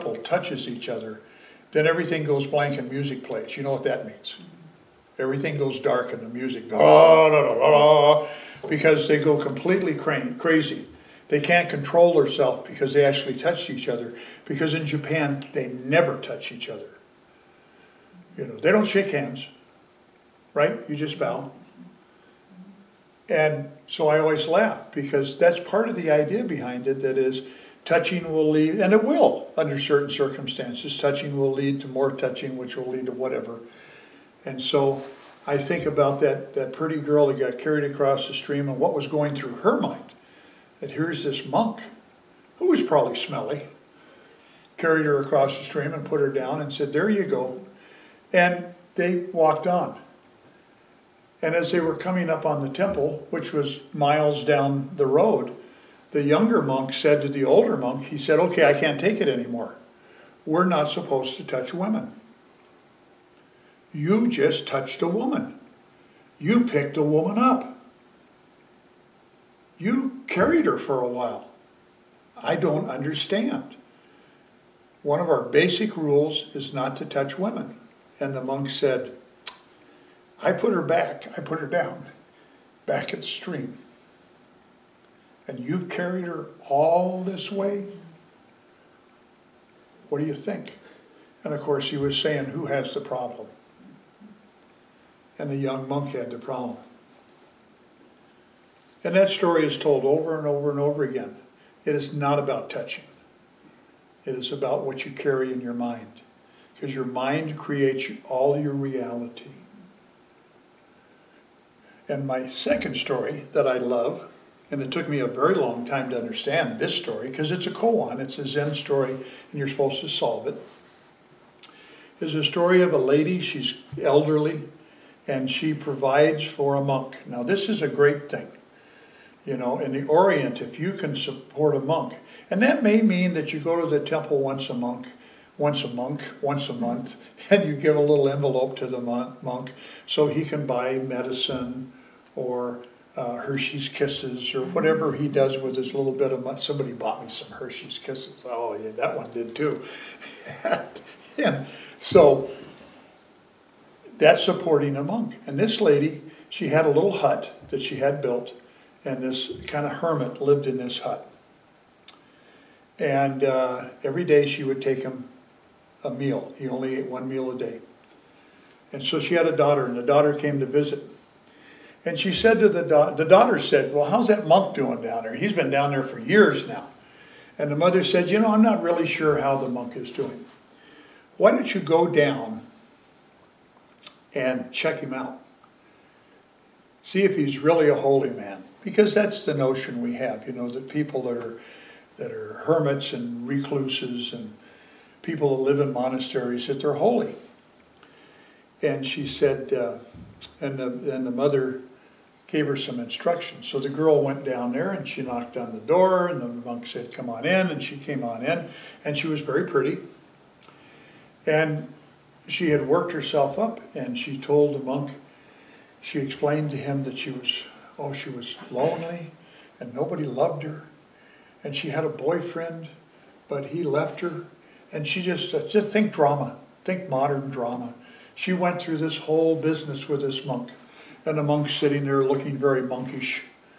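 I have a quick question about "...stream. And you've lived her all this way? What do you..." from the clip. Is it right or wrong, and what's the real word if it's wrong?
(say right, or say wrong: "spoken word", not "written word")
wrong: "carried", not "lived".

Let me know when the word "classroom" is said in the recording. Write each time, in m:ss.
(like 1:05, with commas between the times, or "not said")
not said.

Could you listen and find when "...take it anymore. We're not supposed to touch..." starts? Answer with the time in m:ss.
0:58.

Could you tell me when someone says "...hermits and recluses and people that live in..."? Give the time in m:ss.
3:12.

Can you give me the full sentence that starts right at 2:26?
Somebody bought me some Hershey's Kisses.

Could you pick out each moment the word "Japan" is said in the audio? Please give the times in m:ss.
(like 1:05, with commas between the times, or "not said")
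0:14.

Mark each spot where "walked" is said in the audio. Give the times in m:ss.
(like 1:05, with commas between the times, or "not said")
0:49.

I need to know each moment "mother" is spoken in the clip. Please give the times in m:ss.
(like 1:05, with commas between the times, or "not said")
2:57, 3:21.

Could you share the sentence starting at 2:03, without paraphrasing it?
She's elderly, and she provides for a monk.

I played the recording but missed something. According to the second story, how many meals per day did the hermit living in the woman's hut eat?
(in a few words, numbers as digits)
1.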